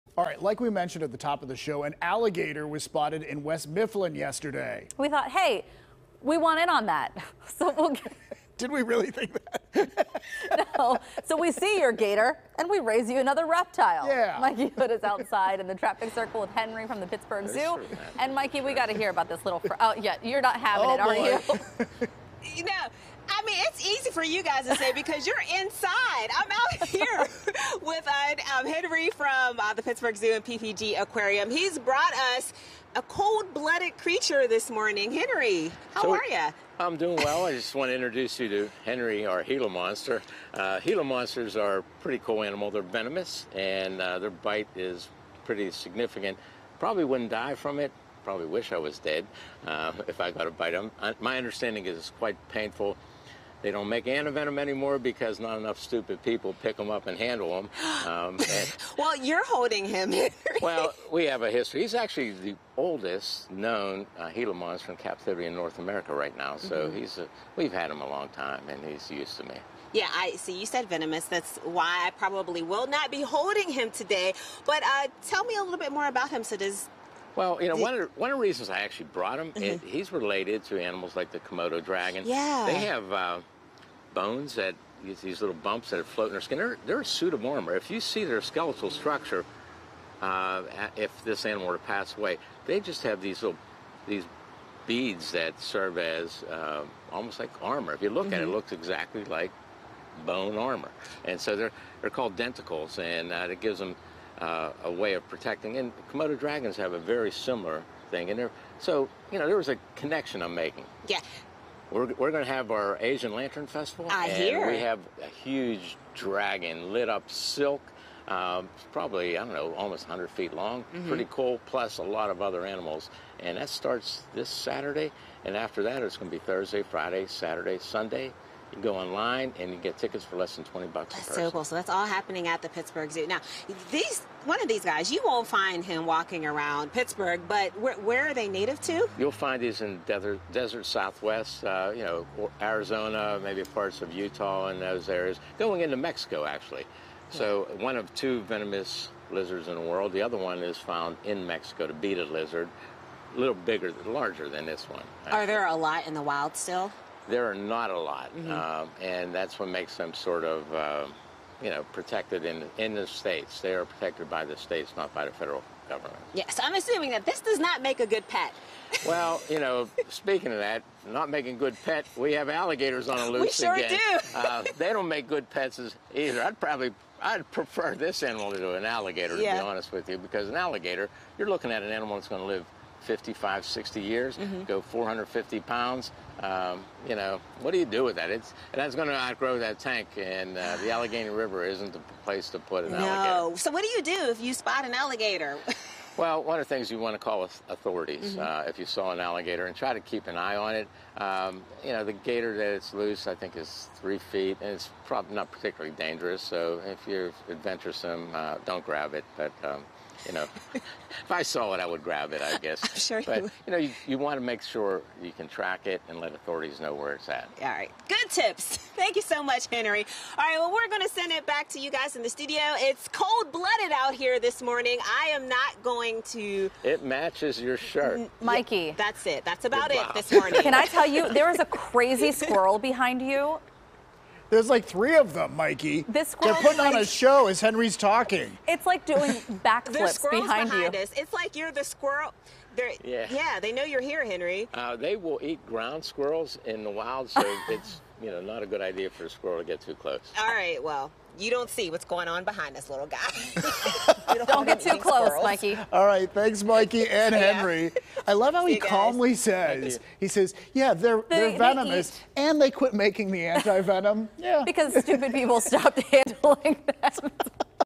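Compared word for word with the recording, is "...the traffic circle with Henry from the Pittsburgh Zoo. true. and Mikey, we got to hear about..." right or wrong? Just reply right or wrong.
right.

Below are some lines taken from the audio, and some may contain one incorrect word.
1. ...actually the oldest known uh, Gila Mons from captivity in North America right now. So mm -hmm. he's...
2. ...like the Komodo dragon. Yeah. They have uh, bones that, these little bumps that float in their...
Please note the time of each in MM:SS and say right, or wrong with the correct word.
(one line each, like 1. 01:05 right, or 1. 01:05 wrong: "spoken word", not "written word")
1. 01:01 right
2. 01:21 right.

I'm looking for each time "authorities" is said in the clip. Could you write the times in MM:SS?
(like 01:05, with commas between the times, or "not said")
03:17, 03:36.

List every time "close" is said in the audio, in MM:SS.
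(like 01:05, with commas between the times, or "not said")
04:09, 04:14.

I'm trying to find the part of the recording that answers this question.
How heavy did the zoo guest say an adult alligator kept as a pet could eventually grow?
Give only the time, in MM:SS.
03:04.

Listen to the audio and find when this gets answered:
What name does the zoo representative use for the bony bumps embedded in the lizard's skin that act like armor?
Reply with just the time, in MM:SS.
01:42.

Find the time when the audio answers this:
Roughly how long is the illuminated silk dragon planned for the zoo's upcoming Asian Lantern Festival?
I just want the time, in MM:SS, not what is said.
01:59.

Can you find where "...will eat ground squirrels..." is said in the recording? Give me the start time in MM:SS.
04:05.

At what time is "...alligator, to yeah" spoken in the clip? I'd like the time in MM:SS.
02:58.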